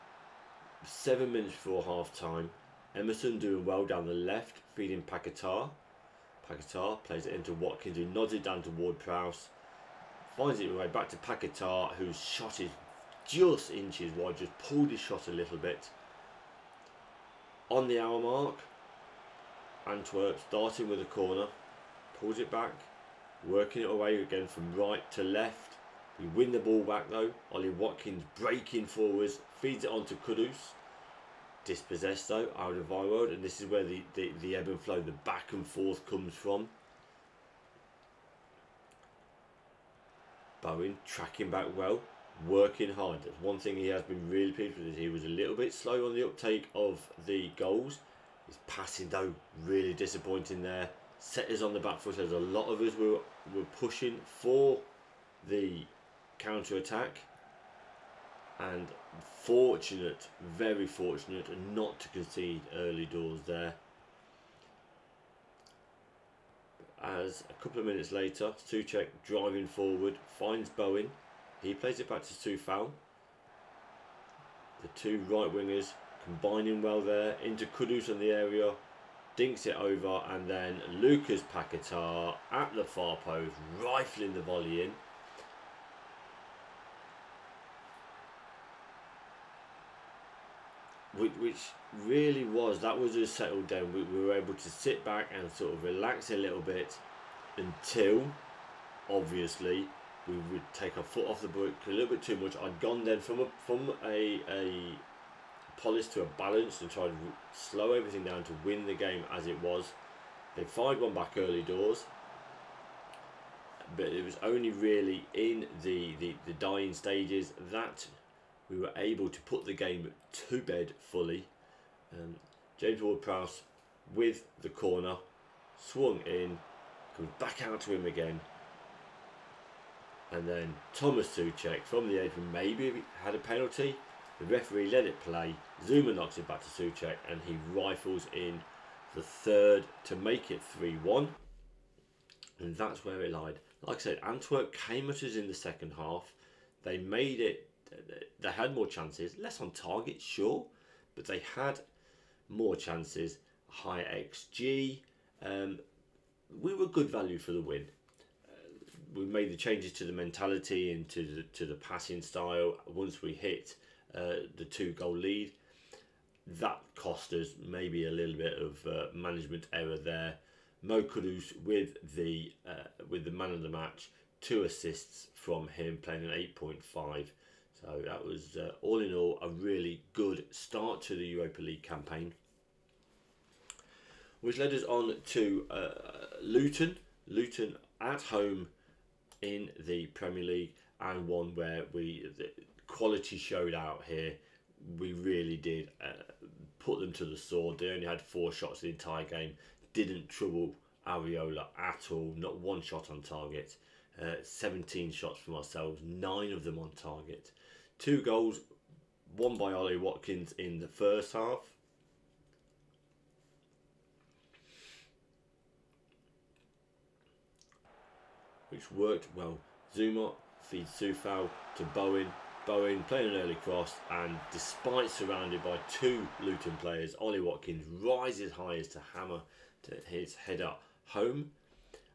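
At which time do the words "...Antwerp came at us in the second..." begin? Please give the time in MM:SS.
02:24.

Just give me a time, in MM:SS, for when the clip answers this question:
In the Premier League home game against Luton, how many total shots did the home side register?
03:24.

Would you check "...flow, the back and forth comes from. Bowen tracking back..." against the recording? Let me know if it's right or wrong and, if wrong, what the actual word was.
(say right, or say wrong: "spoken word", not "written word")
right.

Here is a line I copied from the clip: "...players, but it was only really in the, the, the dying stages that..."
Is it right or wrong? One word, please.
wrong.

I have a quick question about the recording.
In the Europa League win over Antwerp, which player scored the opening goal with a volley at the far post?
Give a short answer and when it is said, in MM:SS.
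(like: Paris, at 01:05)
Lucas Paquetá, at 01:20.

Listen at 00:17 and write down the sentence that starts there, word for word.
On the hour mark, Antwerp starting with a corner, pulls it back, working it away again from right to left.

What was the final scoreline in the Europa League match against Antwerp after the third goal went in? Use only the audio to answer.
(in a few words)
3-1.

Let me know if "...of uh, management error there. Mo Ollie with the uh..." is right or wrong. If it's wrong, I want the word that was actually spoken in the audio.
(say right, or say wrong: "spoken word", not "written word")
wrong: "Kudus", not "Ollie".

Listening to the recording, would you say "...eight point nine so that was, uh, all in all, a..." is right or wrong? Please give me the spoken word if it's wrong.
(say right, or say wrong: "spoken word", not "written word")
wrong: "five", not "nine".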